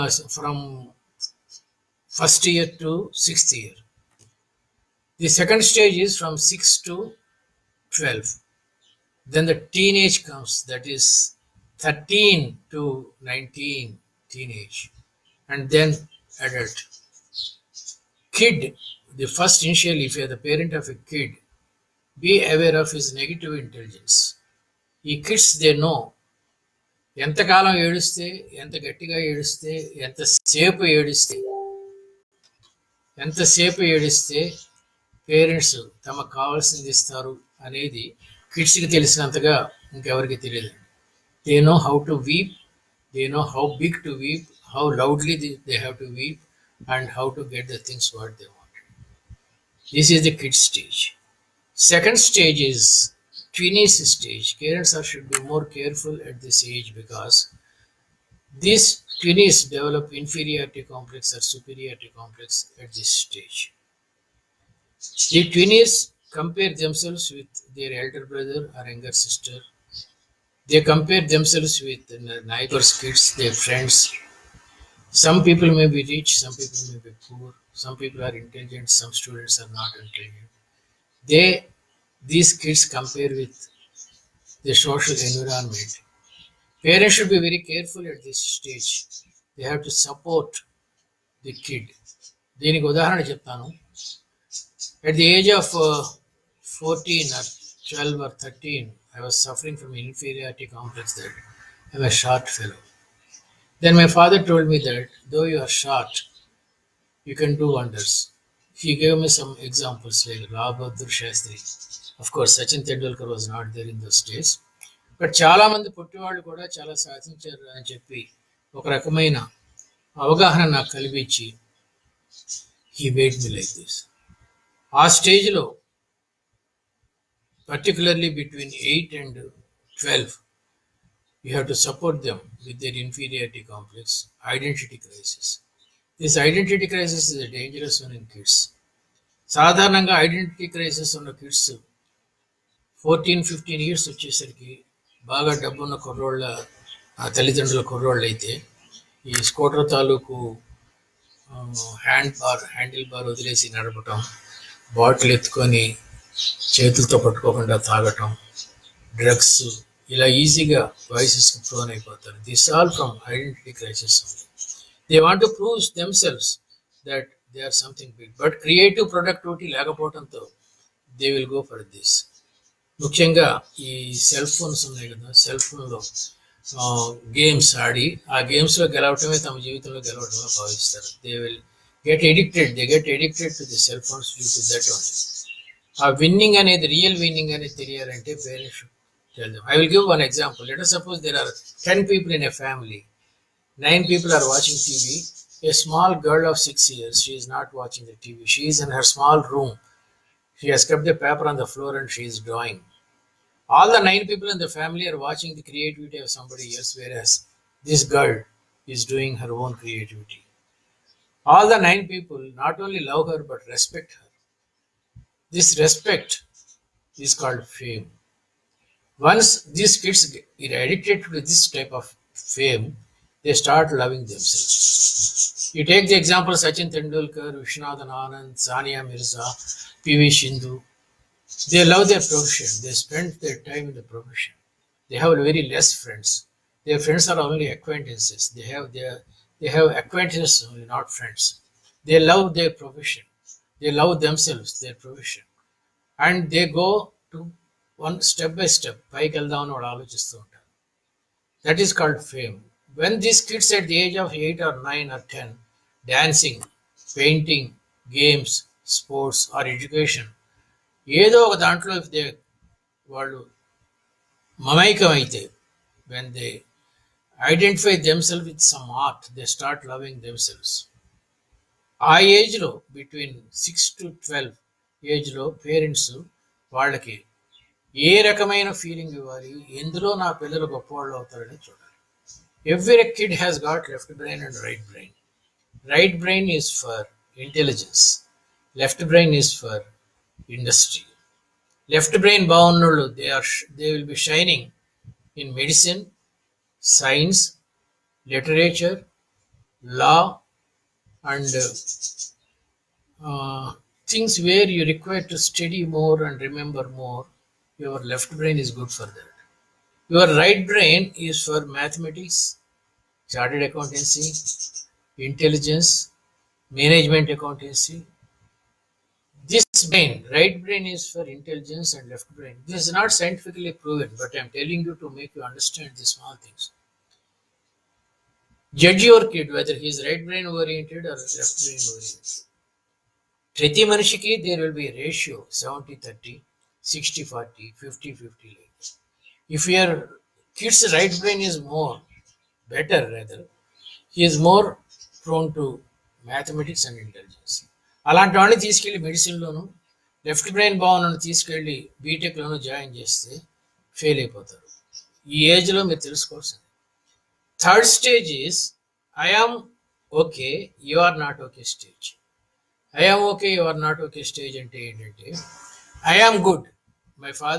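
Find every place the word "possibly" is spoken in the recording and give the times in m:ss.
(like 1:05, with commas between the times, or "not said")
not said.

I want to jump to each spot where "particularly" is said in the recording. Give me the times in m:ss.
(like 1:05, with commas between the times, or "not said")
2:07.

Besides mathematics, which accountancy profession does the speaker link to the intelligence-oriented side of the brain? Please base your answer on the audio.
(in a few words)
chartered accountancy.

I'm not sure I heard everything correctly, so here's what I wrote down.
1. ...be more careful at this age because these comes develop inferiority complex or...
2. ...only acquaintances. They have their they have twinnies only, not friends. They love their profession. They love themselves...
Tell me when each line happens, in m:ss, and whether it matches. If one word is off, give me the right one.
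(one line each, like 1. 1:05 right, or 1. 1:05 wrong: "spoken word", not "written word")
1. 0:55 wrong: "twinnies", not "comes"
2. 3:57 wrong: "acquaintances", not "twinnies".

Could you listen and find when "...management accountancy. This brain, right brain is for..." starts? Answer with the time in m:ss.
5:16.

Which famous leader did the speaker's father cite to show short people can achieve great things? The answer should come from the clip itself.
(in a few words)
Bahadur Shastri.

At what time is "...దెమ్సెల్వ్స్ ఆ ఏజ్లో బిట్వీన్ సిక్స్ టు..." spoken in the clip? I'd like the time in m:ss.
4:30.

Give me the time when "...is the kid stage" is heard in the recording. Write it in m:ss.
0:50.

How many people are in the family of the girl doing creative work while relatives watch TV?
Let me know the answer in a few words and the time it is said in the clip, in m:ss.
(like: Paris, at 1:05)
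10, at 3:11.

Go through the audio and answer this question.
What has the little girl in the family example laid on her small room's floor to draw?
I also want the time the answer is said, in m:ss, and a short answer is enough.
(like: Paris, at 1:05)
a paper, at 3:21.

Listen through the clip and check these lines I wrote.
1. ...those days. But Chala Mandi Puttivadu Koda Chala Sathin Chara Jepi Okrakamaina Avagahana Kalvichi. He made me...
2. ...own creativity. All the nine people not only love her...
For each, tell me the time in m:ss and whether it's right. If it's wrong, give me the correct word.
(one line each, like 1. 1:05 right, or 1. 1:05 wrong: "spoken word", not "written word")
1. 1:53 right
2. 3:29 right.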